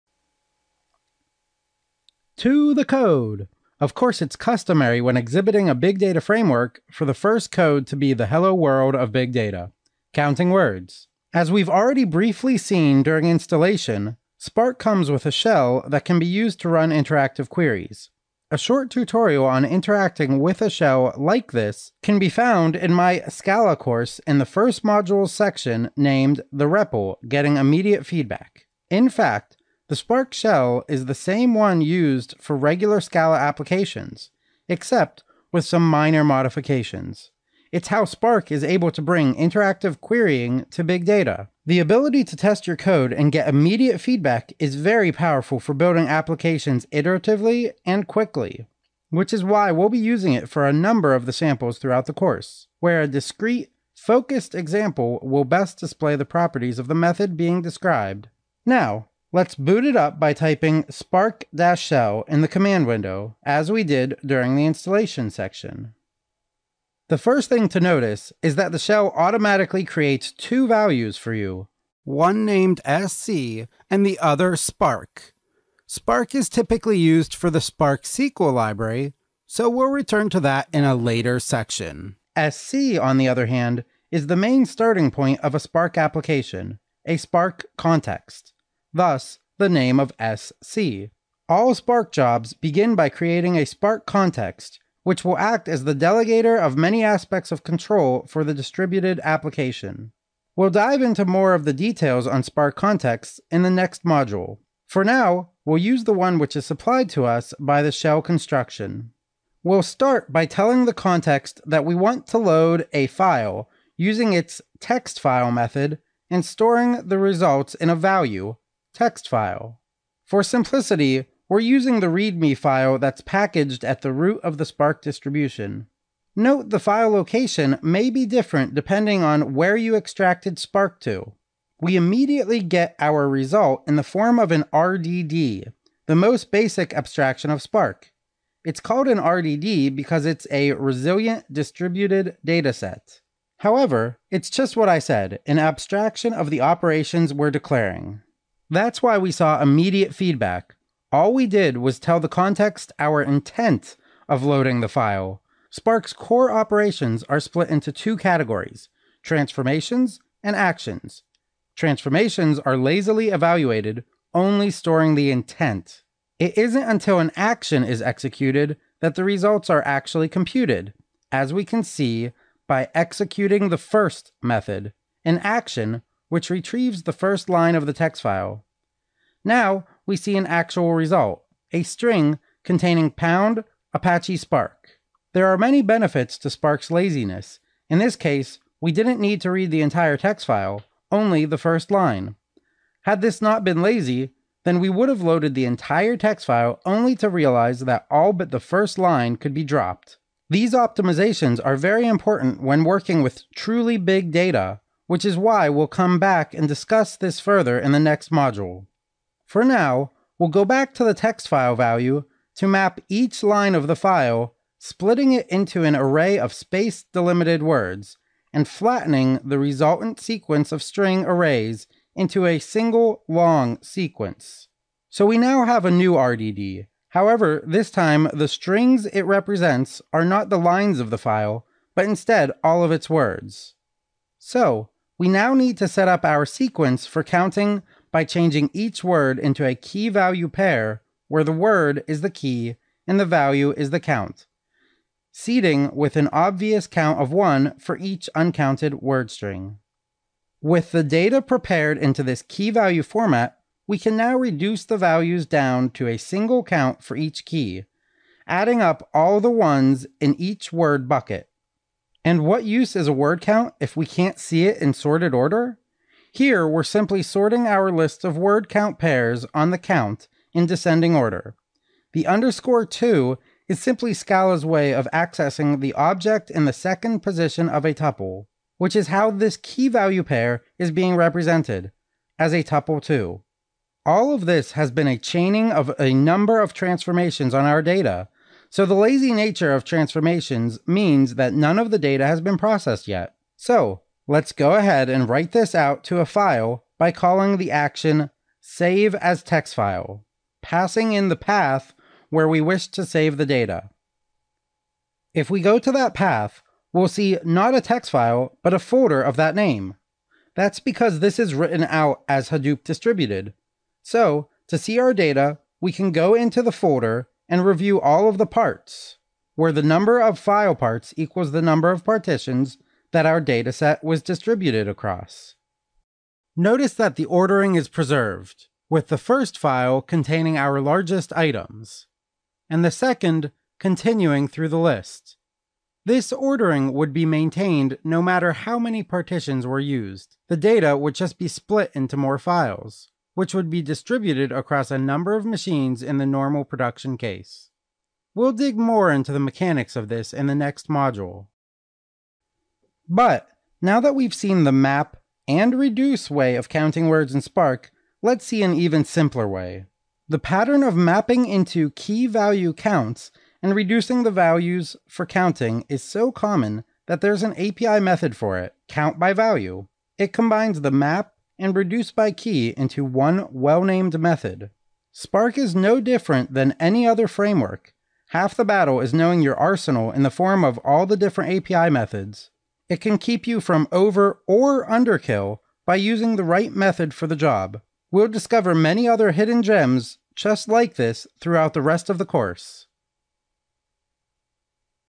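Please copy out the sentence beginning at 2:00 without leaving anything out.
For simplicity, we're using the README file that's packaged at the root of the Spark distribution.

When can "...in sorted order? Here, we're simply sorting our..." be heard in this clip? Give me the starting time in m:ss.
4:24.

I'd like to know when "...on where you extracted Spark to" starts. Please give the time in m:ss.
2:09.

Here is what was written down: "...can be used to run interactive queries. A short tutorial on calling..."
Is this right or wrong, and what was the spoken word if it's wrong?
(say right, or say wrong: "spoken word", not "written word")
wrong: "interacting", not "calling".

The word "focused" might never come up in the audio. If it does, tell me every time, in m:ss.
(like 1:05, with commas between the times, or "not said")
0:53.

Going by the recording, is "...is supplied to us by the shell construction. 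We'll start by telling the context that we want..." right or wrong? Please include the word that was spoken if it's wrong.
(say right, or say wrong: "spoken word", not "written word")
right.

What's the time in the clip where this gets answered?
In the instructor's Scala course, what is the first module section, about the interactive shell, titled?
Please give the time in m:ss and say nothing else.
0:26.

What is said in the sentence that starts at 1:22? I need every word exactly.
SC, on the other hand, is the main starting point of a Spark application, a Spark context thus, the name of SC.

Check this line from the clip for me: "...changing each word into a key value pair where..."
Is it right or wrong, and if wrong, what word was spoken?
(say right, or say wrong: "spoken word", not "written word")
right.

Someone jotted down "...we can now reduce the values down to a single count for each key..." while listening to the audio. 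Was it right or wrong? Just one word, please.
right.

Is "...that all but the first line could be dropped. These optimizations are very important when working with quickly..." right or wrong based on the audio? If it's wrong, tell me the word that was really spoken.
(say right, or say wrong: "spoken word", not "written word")
wrong: "truly", not "quickly".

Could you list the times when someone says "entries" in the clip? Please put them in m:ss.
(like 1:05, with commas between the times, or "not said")
not said.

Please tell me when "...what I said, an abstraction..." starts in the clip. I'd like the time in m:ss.
2:24.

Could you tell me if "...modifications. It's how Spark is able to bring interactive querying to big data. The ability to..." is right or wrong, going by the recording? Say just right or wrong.
right.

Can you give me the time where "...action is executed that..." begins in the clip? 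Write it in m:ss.
2:47.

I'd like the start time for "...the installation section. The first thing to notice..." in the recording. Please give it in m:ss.
1:04.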